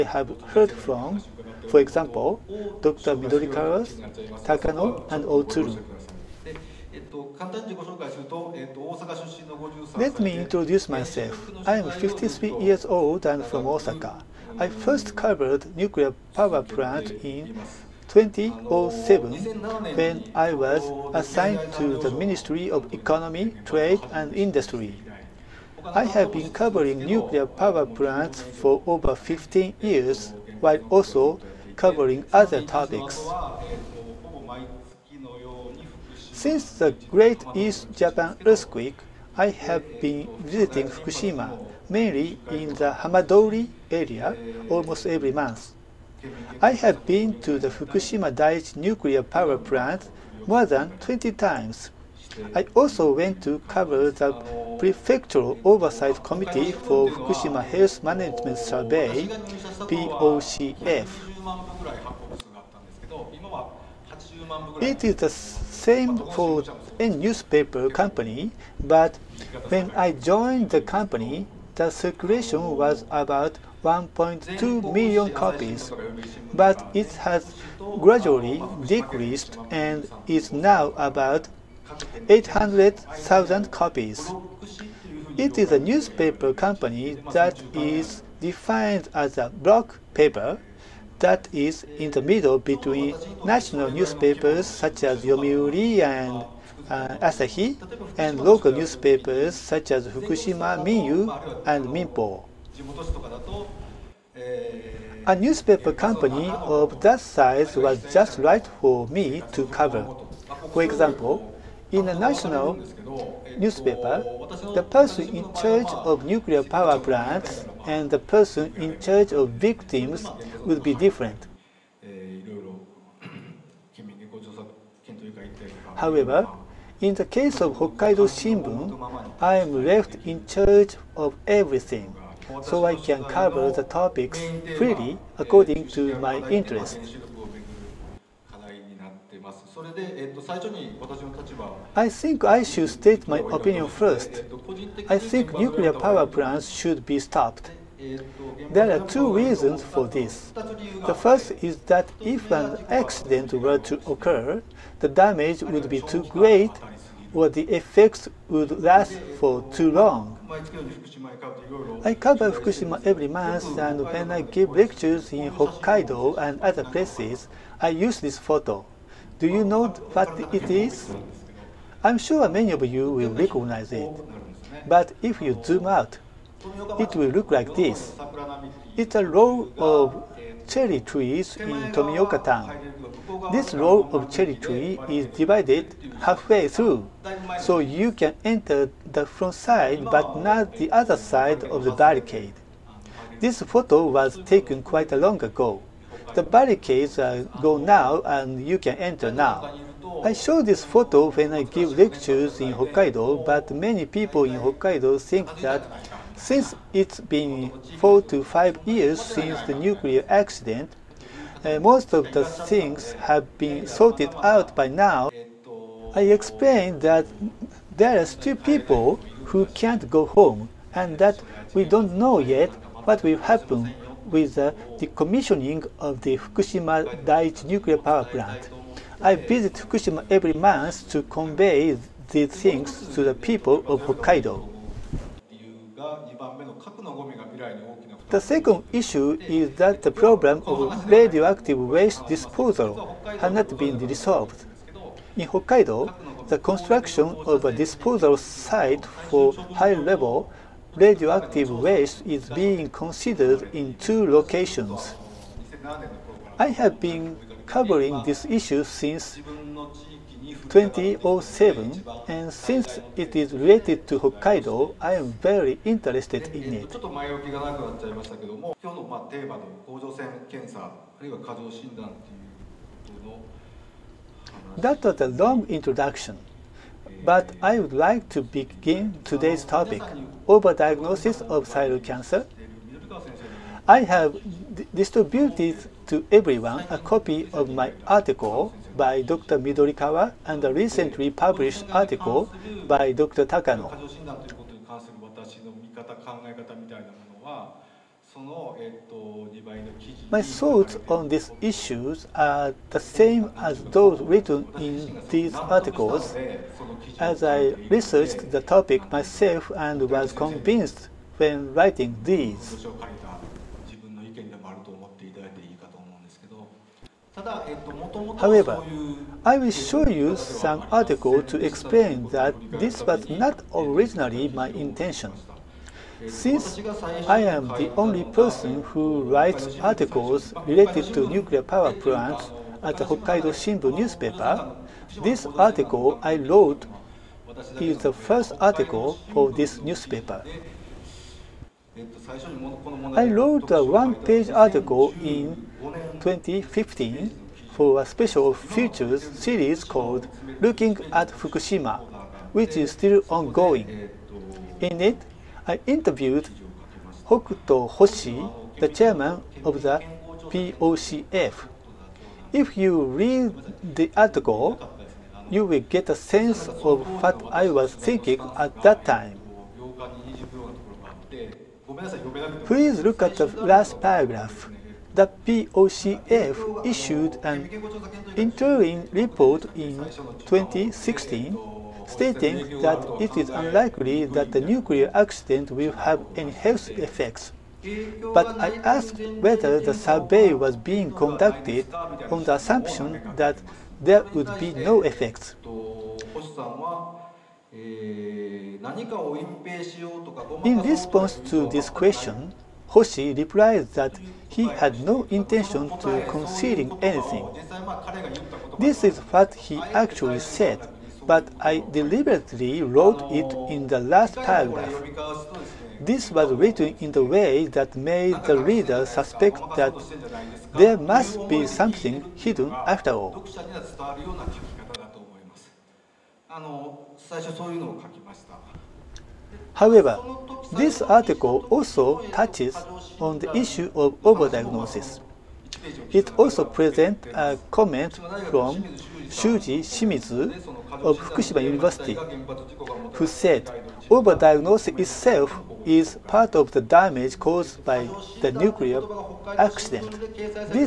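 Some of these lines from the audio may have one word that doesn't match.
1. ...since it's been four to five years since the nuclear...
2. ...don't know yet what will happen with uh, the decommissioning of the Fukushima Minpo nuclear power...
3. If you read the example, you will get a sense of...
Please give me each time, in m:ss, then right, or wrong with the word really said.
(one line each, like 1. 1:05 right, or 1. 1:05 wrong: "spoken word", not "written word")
1. 3:26 right
2. 3:41 wrong: "Daiichi", not "Minpo"
3. 6:02 wrong: "article", not "example".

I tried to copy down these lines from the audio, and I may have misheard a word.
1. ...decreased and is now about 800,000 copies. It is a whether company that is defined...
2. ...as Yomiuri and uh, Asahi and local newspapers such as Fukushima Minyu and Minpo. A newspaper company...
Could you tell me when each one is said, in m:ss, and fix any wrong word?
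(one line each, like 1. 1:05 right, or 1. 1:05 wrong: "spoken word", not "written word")
1. 1:18 wrong: "newspaper", not "whether"
2. 1:35 right.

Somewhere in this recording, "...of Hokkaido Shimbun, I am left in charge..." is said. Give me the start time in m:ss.
2:07.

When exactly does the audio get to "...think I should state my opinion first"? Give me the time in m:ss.
2:22.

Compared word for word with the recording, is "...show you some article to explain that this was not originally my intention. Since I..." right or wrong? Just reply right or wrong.
right.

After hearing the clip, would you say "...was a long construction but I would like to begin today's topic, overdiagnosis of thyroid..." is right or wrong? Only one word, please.
wrong.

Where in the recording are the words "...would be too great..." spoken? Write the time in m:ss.
2:35.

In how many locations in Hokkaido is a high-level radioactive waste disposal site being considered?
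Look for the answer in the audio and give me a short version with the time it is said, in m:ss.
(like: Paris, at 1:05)
2, at 4:13.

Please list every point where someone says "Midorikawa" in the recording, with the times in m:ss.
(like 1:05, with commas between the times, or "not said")
0:03, 4:49.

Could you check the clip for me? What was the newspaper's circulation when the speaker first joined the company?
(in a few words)
1.2 million copies.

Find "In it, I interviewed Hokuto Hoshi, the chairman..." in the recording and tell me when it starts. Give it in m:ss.
5:54.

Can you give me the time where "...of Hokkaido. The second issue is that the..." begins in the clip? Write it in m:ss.
3:53.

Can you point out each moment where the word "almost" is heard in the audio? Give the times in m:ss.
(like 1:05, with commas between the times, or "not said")
0:44.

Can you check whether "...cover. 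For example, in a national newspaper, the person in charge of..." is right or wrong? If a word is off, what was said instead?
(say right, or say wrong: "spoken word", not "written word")
right.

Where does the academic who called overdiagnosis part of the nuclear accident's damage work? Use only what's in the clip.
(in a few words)
Fukushima University.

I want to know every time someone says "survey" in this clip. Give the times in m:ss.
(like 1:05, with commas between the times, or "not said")
0:58, 6:30.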